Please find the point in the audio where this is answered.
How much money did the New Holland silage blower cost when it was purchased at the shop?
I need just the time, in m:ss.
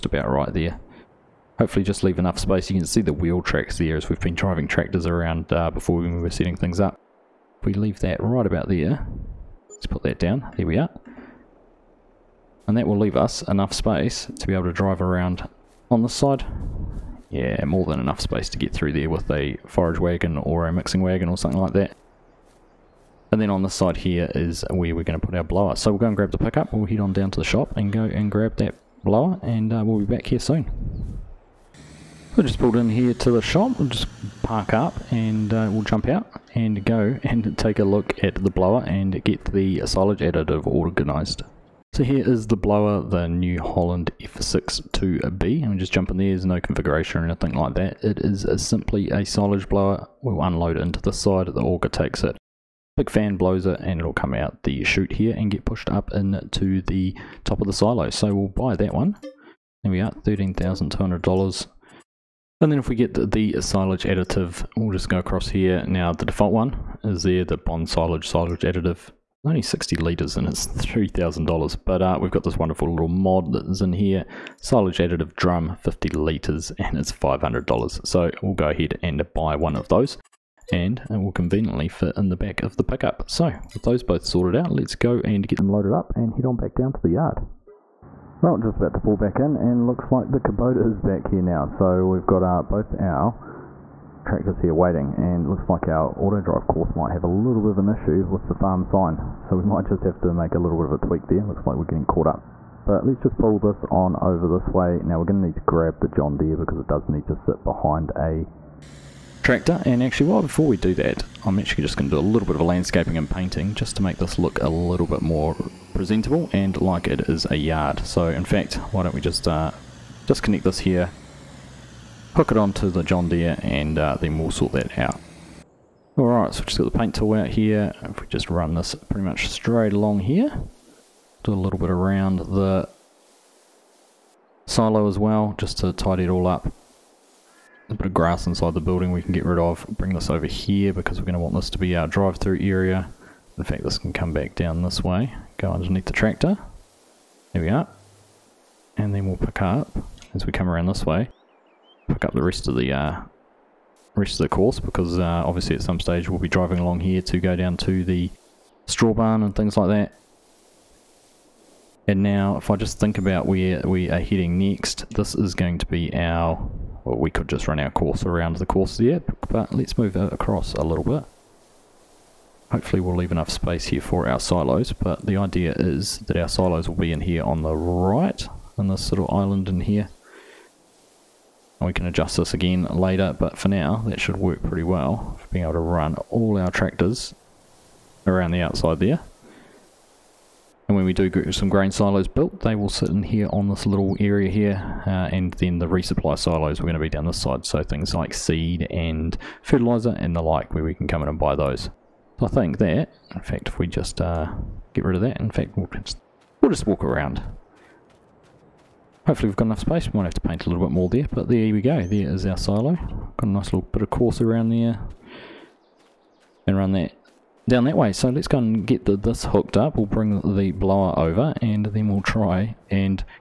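1:00.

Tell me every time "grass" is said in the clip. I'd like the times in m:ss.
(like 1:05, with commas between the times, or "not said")
2:18.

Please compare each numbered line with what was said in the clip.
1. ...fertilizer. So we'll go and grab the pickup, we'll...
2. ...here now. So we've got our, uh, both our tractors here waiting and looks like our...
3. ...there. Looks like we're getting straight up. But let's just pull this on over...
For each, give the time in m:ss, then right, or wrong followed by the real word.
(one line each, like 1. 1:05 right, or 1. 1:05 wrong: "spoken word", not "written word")
1. 0:25 wrong: "blower", not "fertilizer"
2. 1:31 right
3. 1:41 wrong: "caught", not "straight".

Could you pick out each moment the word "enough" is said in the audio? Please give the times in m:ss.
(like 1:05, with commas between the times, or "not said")
0:02, 0:13, 0:17, 2:53, 3:29.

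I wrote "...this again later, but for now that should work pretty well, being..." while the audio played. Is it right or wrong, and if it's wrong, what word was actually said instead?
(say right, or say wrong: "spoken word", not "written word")
right.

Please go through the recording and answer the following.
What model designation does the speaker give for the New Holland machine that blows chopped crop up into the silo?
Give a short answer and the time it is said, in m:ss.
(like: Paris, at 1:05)
F62B, at 0:44.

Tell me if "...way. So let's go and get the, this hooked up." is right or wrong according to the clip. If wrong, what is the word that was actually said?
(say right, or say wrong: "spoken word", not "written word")
right.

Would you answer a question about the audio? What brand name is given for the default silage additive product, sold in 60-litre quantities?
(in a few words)
Bonsilage.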